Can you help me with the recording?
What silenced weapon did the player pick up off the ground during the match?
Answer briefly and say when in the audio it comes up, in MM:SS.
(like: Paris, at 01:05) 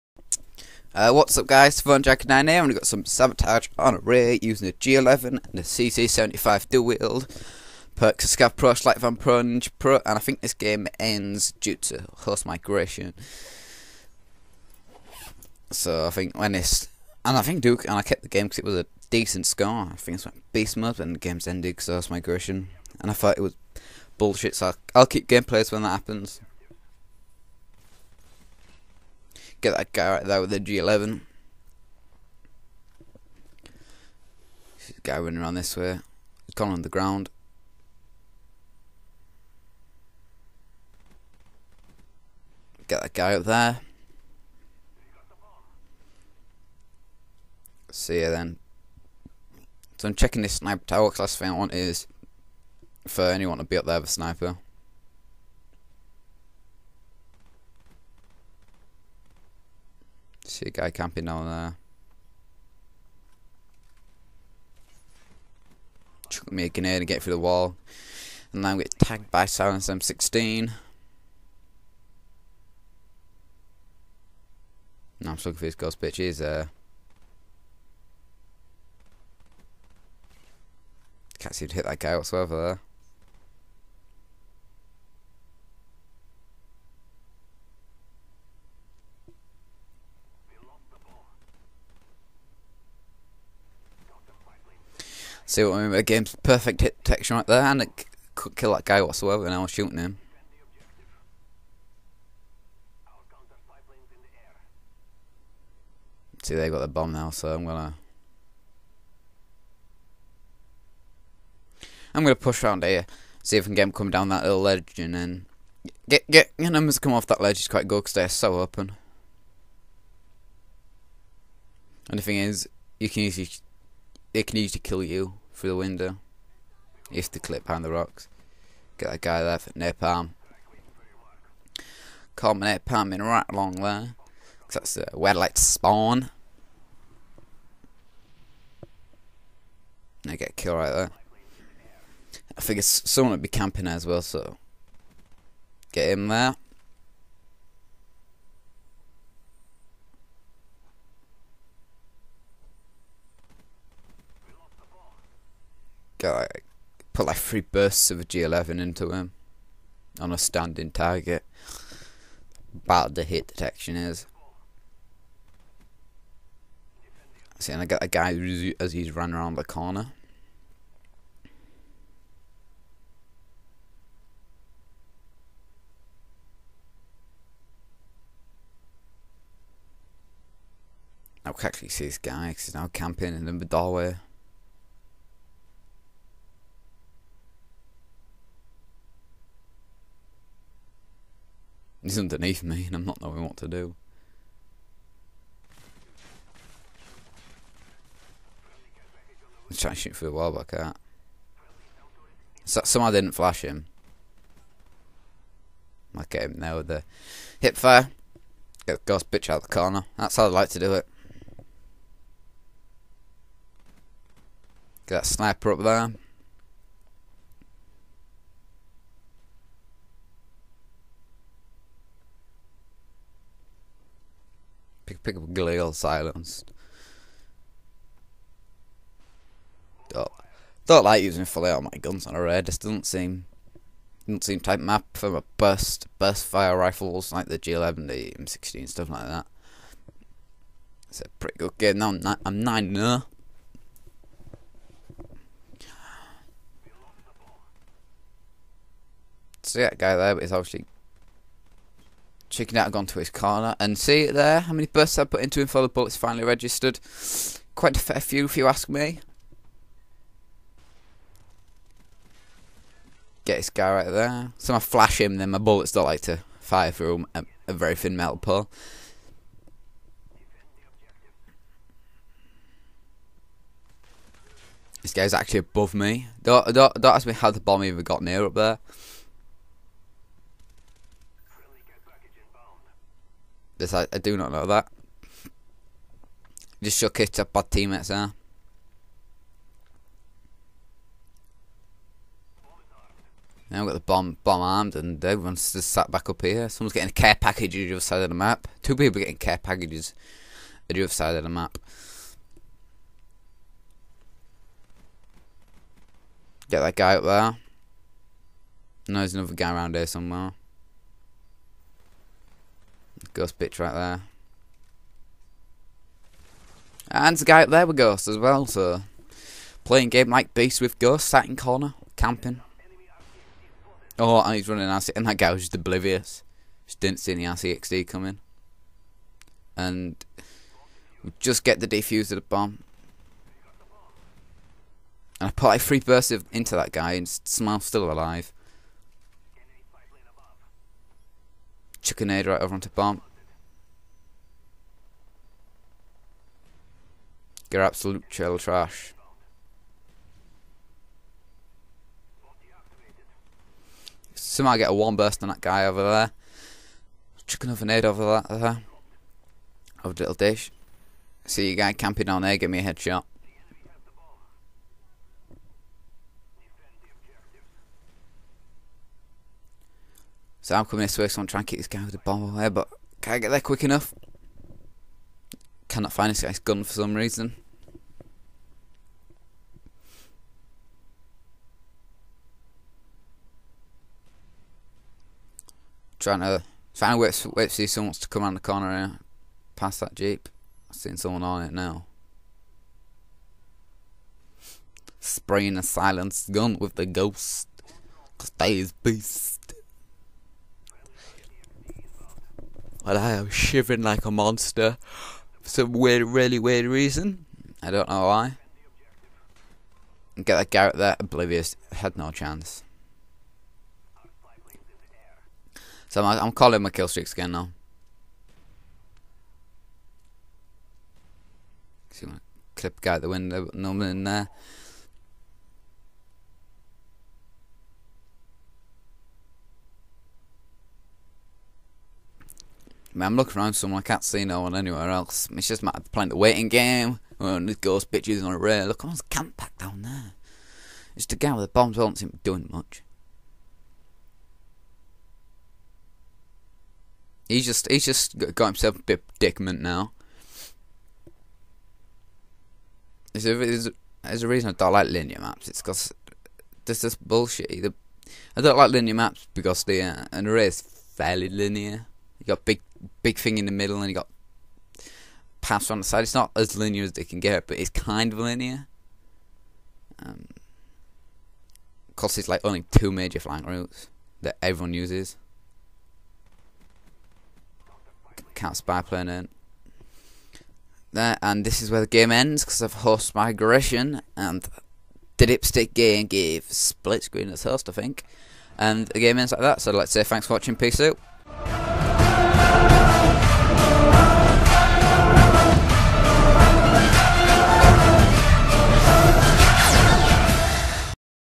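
Galil, at 03:45.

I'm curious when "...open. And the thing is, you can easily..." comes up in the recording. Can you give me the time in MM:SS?
01:58.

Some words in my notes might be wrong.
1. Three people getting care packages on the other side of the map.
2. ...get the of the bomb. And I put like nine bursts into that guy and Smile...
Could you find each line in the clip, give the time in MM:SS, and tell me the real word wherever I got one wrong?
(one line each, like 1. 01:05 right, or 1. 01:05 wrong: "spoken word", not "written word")
1. 04:58 wrong: "Two", not "Three"
2. 05:31 wrong: "three", not "nine".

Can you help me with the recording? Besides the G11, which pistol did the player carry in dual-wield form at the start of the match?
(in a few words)
CZ75.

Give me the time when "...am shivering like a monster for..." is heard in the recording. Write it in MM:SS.
06:43.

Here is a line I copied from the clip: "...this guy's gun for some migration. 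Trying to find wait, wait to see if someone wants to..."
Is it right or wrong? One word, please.
wrong.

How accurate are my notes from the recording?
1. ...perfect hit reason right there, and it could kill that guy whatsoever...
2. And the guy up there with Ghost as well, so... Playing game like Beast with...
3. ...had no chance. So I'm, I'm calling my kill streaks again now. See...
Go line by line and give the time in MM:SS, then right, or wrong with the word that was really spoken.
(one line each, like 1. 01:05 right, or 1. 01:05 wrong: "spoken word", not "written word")
1. 01:36 wrong: "detection", not "reason"
2. 05:17 right
3. 06:51 right.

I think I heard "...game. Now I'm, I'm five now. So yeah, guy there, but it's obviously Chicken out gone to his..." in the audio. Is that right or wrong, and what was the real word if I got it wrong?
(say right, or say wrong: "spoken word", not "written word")
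wrong: "nine", not "five".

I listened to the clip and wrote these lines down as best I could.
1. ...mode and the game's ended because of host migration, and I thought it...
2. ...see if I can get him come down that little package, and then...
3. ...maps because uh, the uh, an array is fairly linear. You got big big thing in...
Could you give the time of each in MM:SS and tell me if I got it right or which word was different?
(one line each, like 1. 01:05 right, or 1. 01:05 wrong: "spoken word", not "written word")
1. 00:20 right
2. 01:53 wrong: "ledge", not "package"
3. 07:39 right.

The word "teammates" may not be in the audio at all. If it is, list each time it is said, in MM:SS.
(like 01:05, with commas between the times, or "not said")
04:47.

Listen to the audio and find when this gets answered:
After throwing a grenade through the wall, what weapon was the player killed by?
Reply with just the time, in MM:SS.
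01:09.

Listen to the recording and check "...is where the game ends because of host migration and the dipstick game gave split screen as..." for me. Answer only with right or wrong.
right.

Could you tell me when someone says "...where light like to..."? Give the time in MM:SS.
02:15.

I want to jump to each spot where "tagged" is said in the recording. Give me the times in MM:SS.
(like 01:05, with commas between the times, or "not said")
01:08.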